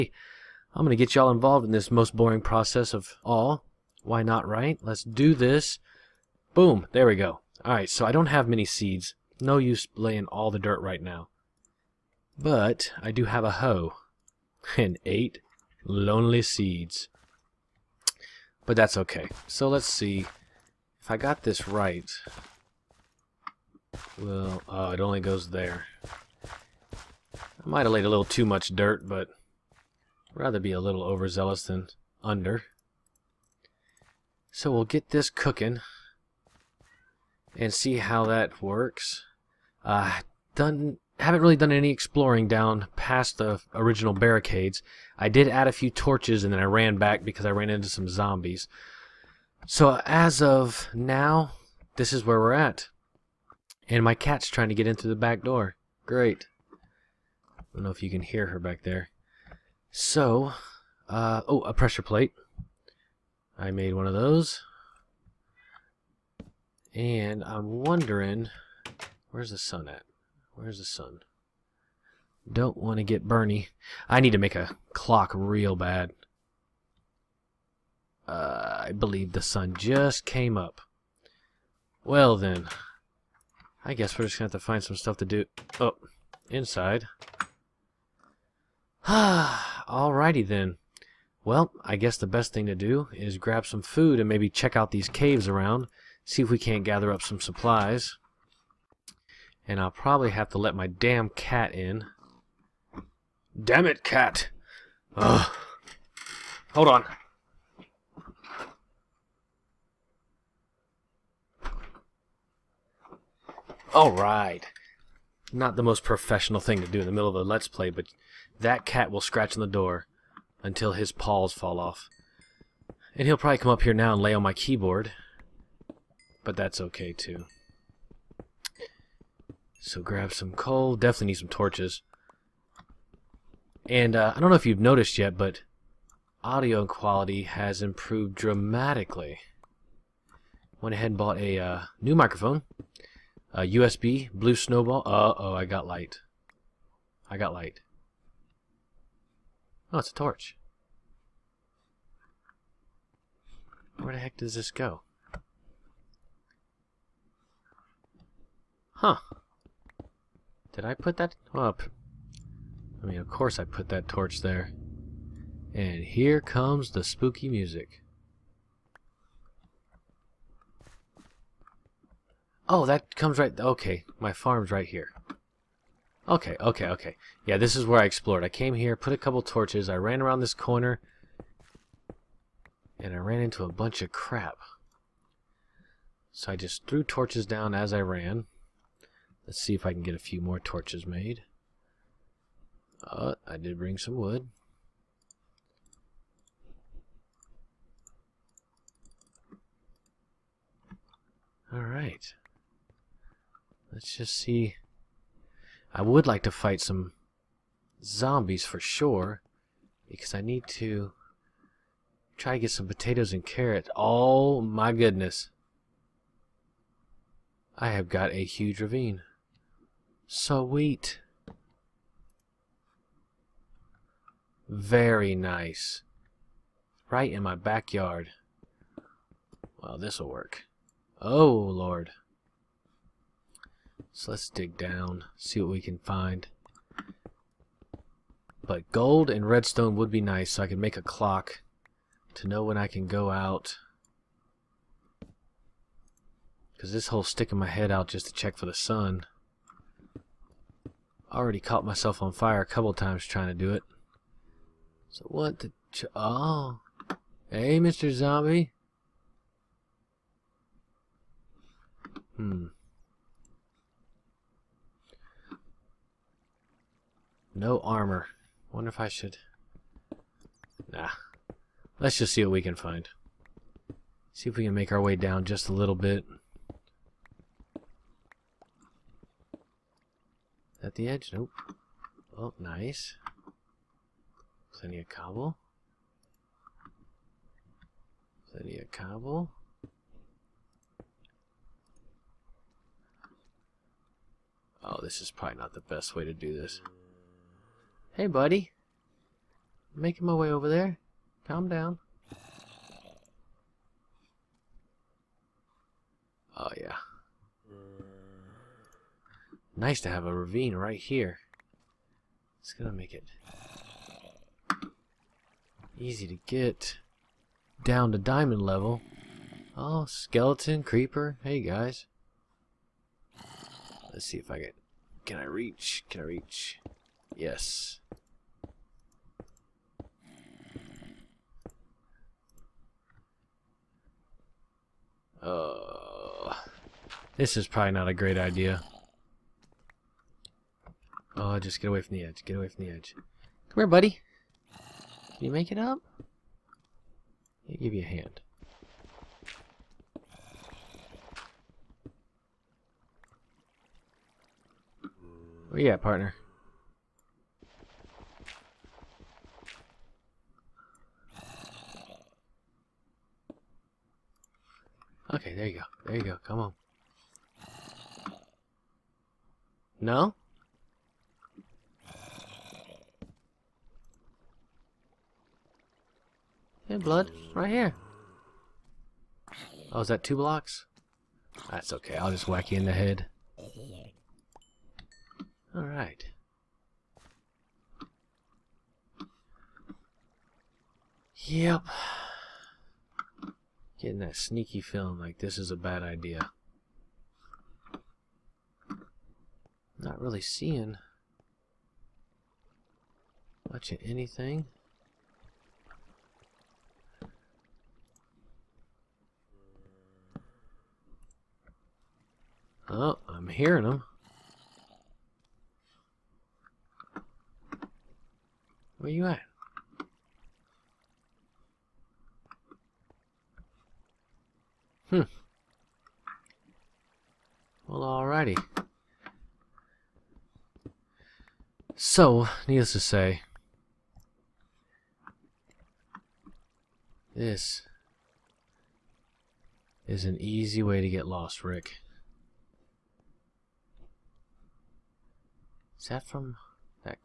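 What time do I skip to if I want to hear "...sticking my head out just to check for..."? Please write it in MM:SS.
04:07.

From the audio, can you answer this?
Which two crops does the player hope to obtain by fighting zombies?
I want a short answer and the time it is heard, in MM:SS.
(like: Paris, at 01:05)
Potatoes and carrots, at 03:32.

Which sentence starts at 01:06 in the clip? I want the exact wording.
And I'm wondering, where's the sun at?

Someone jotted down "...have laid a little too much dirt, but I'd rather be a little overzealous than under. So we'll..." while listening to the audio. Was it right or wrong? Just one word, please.
right.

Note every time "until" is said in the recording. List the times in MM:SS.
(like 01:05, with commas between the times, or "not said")
02:00.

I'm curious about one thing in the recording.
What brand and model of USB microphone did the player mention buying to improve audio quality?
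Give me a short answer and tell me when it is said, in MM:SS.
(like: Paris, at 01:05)
Blue Snowball, at 02:24.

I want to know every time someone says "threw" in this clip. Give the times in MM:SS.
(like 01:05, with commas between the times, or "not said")
03:06.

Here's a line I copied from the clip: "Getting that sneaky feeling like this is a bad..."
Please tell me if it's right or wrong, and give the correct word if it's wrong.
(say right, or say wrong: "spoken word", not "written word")
right.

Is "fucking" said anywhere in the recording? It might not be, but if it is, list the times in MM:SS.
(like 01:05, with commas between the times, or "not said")
not said.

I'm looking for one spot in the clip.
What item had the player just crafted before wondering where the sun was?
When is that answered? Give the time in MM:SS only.
01:01.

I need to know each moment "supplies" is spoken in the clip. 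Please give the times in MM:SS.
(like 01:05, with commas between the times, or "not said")
01:37.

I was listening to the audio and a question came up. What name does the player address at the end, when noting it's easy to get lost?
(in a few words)
Rick.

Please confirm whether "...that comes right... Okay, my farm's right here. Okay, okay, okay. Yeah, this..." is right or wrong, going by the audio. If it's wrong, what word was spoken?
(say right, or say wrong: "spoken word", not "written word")
right.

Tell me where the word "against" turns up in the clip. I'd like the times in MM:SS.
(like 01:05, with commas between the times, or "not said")
not said.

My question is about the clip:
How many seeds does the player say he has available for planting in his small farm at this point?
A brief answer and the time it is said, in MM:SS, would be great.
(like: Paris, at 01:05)
8, at 00:15.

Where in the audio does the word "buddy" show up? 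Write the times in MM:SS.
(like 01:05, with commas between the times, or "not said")
04:58, 05:43.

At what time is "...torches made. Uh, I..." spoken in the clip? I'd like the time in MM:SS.
03:10.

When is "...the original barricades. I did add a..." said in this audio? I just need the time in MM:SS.
00:43.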